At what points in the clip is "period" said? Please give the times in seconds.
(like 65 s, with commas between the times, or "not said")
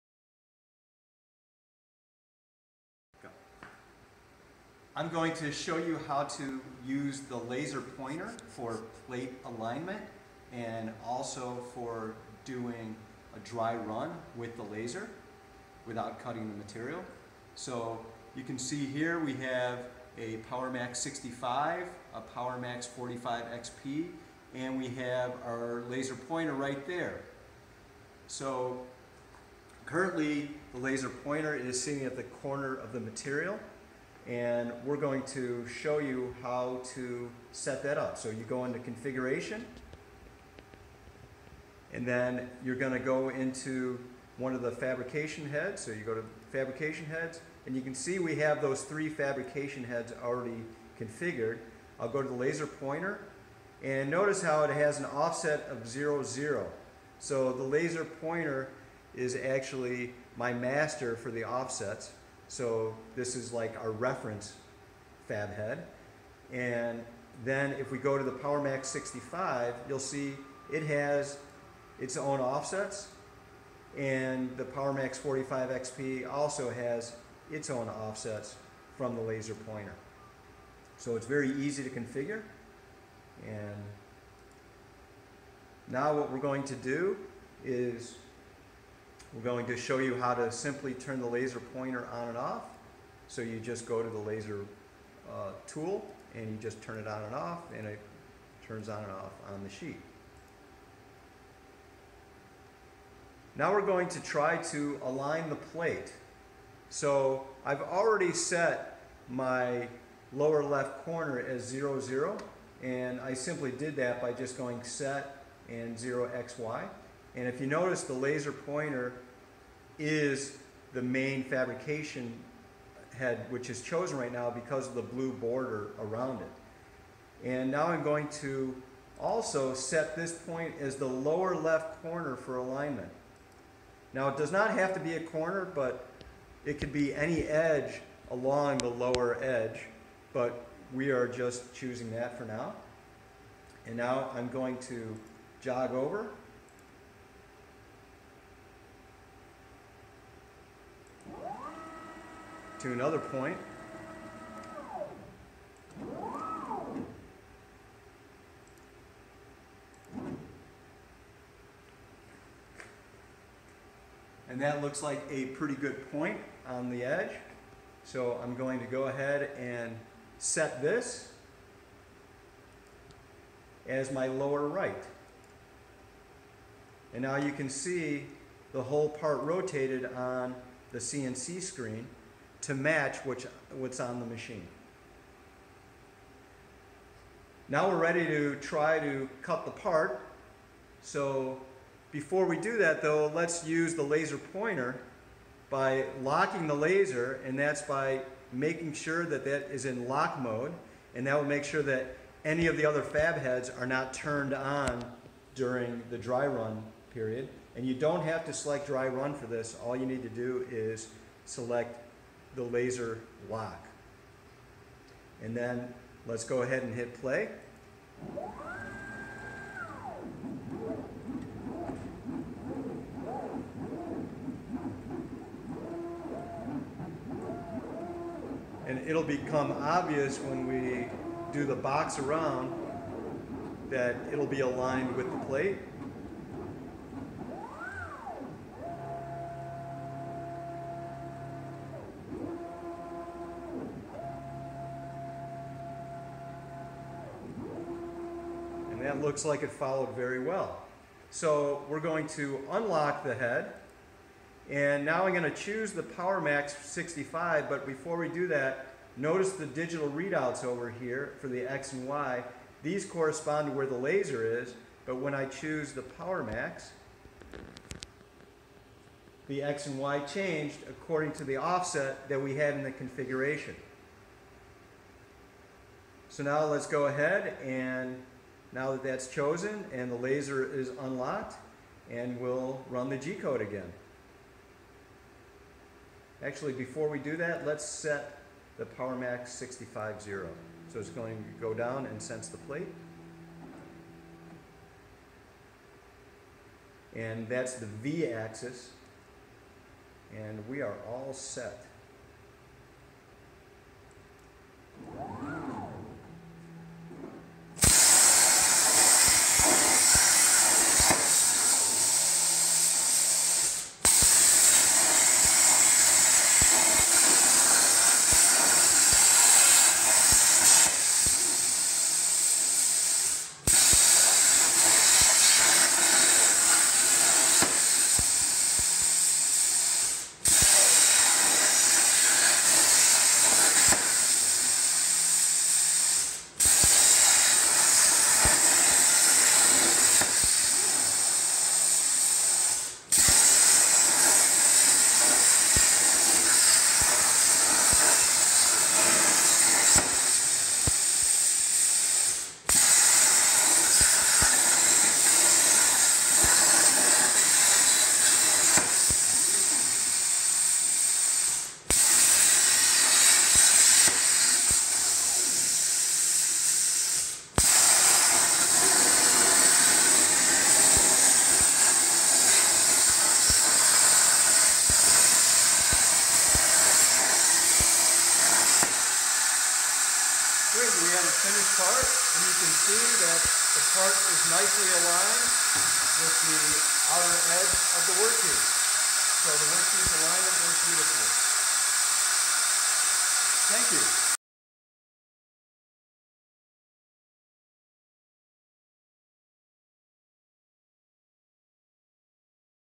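207 s.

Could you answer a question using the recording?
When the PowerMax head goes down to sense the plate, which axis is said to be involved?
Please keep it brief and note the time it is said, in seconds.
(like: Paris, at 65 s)
V axis, at 297 s.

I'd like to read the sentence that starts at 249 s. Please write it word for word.
it looks like it followed very well.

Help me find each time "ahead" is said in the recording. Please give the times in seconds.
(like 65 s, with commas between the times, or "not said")
169 s, 216 s, 277 s.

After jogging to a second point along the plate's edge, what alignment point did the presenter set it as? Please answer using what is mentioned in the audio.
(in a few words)
Lower right.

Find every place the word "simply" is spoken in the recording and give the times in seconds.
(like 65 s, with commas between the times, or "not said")
90 s, 113 s.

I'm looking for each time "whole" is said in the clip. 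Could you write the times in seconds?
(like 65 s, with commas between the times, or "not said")
178 s.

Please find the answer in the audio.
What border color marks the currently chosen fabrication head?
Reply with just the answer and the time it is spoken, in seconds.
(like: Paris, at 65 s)
Blue, at 125 s.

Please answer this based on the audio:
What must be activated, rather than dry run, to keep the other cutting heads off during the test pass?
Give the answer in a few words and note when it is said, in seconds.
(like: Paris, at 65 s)
Laser lock, at 212 s.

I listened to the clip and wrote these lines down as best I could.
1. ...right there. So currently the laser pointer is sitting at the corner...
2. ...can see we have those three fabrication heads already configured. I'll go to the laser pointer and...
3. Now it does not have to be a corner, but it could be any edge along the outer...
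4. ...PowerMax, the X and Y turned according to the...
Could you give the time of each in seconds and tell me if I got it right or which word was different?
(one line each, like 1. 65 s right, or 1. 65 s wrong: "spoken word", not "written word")
1. 26 s right
2. 47 s right
3. 134 s wrong: "lower", not "outer"
4. 266 s wrong: "changed", not "turned".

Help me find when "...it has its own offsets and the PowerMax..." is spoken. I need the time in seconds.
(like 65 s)
70 s.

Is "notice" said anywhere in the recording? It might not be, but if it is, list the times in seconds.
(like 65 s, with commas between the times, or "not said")
54 s, 117 s, 259 s.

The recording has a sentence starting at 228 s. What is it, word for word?
And it'll become obvious when we do the box around that it'll be aligned with the plate.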